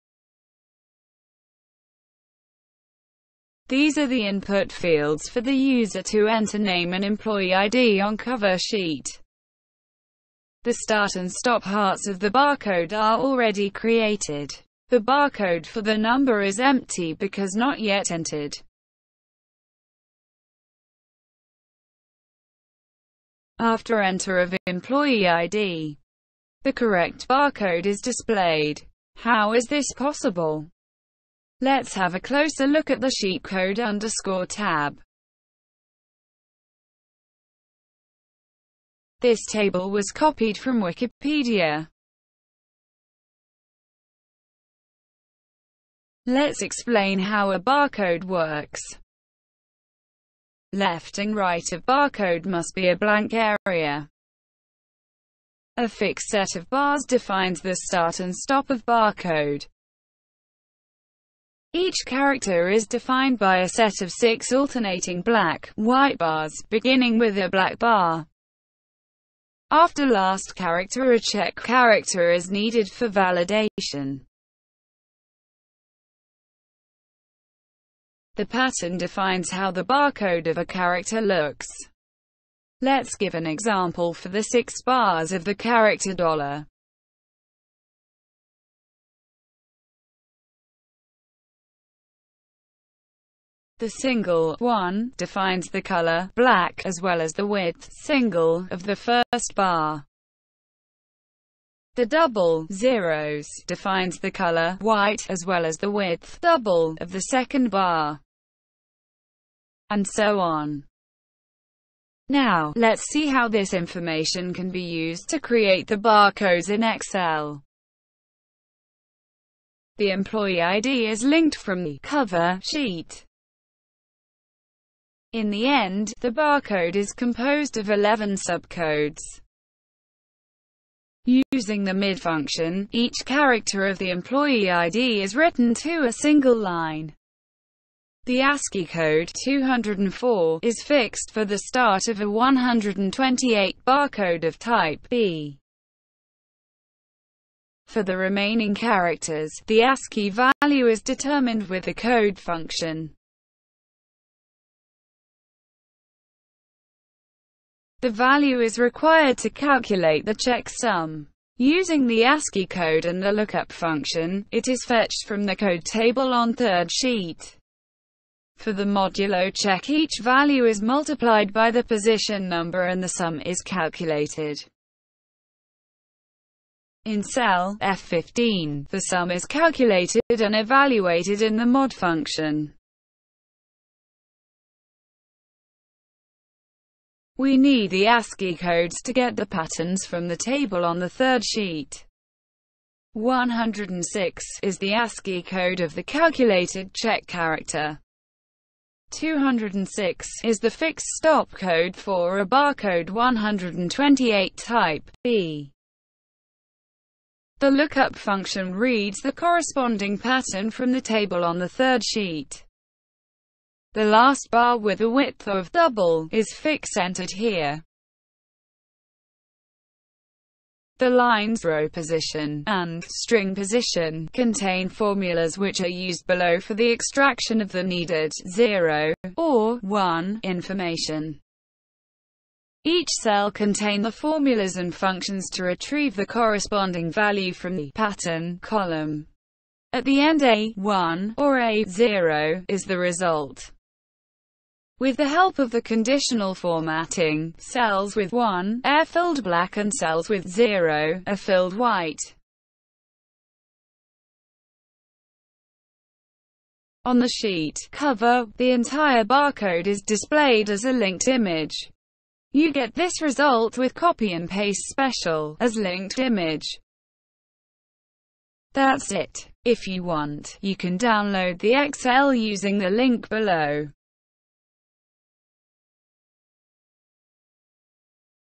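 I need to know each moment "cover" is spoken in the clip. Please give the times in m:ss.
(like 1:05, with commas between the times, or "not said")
0:08, 2:02, 4:17.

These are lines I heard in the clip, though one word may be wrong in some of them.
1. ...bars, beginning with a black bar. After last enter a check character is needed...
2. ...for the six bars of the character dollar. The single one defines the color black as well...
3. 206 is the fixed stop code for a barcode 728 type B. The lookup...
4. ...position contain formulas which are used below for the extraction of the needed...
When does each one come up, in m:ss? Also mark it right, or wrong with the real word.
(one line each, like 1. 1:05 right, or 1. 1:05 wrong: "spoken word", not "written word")
1. 1:06 wrong: "character", not "enter"
2. 1:24 right
3. 3:19 wrong: "128", not "728"
4. 3:43 right.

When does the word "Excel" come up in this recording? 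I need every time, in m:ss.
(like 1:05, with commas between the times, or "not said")
1:56, 4:31.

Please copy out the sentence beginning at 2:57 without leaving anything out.
In cell F15, the sum is calculated and evaluated in the mod function.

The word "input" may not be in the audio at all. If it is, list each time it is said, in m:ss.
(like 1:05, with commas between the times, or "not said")
0:04.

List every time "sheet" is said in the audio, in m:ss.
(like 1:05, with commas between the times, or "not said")
0:08, 0:33, 2:02, 2:46, 3:11, 3:32, 4:17.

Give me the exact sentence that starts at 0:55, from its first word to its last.
A fixed set of bars defines the start and stop of barcode.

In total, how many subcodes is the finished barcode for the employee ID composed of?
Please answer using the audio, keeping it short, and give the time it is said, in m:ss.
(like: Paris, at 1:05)
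11, at 2:07.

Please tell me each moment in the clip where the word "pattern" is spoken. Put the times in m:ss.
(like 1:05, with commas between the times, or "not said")
1:18, 3:09, 3:30, 3:57.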